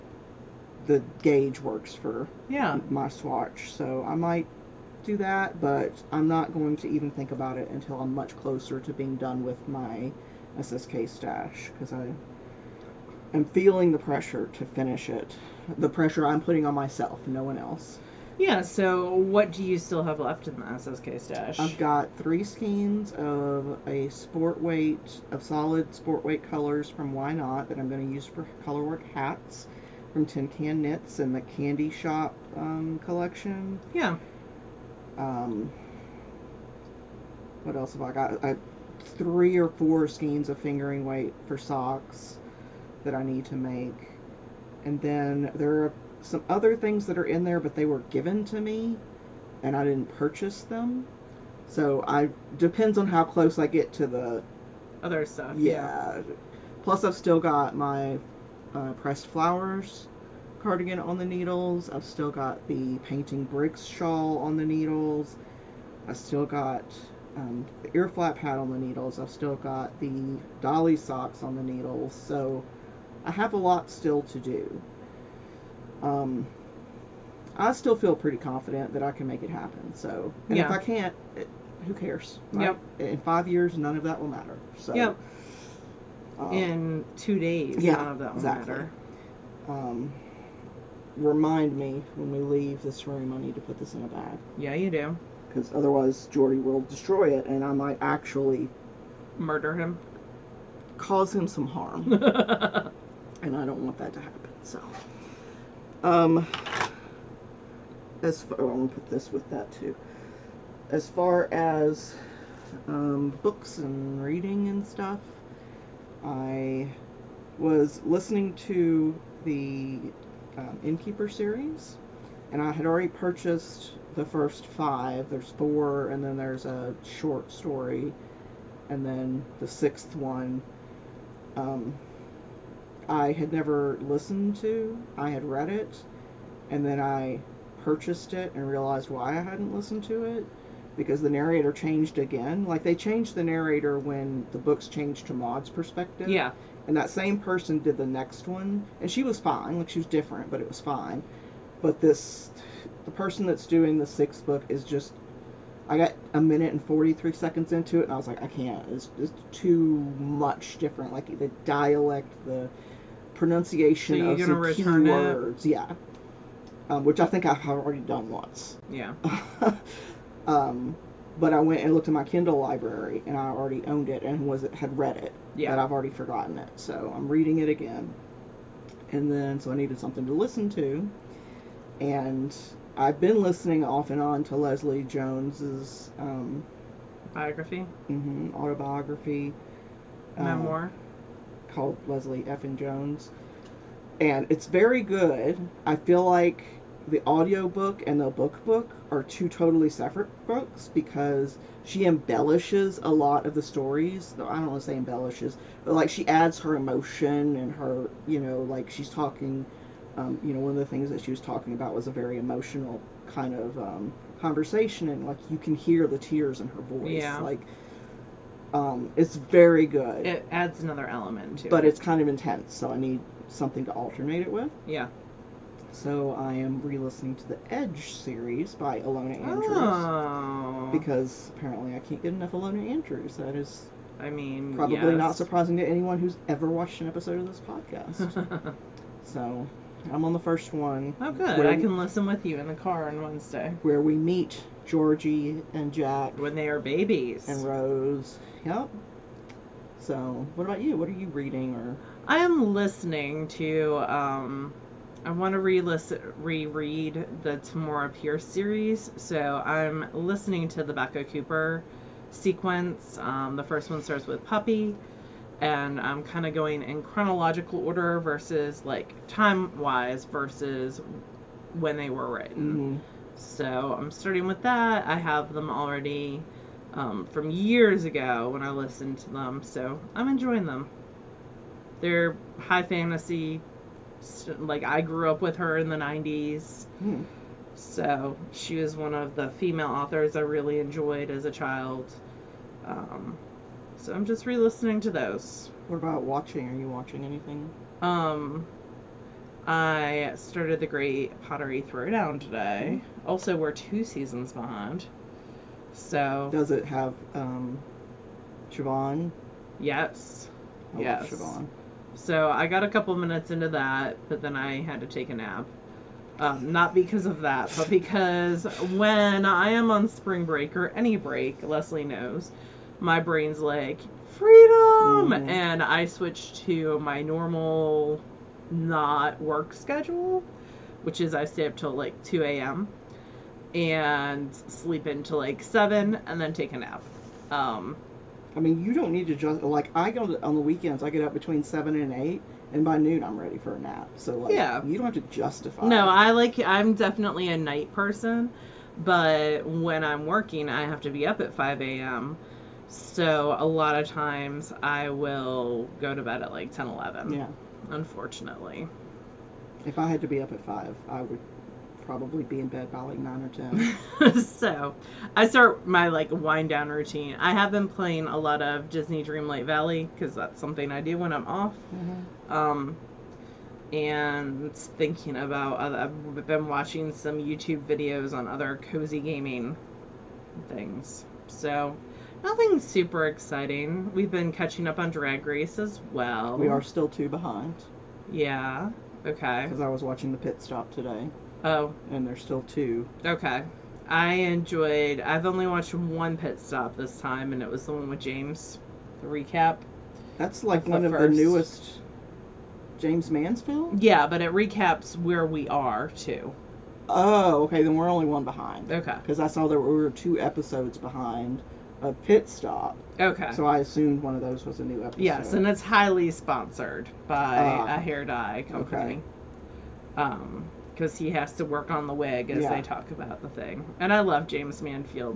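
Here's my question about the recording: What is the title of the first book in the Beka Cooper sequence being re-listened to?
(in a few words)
Puppy.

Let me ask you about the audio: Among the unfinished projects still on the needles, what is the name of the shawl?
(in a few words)
Painting Bricks.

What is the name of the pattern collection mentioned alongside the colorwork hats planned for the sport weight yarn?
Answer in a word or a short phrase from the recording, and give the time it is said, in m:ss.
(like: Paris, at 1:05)
Candy Shop, at 0:31.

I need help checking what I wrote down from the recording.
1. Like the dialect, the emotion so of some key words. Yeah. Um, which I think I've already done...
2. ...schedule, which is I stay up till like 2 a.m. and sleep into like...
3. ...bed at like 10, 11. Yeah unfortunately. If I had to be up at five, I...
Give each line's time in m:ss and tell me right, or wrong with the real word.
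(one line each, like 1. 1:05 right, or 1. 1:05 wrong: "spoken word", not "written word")
1. 2:41 wrong: "pronunciation", not "emotion"
2. 5:29 right
3. 5:56 right.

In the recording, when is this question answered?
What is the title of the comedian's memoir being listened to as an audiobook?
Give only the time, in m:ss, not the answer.
3:12.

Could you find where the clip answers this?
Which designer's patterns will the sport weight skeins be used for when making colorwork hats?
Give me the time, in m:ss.
0:30.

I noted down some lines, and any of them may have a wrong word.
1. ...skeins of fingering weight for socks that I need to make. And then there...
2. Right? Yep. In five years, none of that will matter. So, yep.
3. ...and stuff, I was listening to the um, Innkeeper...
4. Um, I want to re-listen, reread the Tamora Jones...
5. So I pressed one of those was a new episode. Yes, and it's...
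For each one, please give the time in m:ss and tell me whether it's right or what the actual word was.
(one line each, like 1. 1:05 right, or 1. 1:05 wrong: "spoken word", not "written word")
1. 0:40 right
2. 1:22 right
3. 1:54 right
4. 4:14 wrong: "Pierce", not "Jones"
5. 6:53 wrong: "assumed", not "pressed".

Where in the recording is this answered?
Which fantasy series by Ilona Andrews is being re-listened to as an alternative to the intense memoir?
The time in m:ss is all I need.
3:47.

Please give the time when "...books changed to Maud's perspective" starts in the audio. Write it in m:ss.
2:24.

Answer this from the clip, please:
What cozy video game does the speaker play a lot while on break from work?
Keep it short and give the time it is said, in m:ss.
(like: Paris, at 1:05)
Disney Dreamlight Valley, at 6:08.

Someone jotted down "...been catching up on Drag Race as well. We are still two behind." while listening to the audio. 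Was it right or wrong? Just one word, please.
right.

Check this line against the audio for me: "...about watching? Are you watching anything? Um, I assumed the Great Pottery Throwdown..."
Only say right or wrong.
wrong.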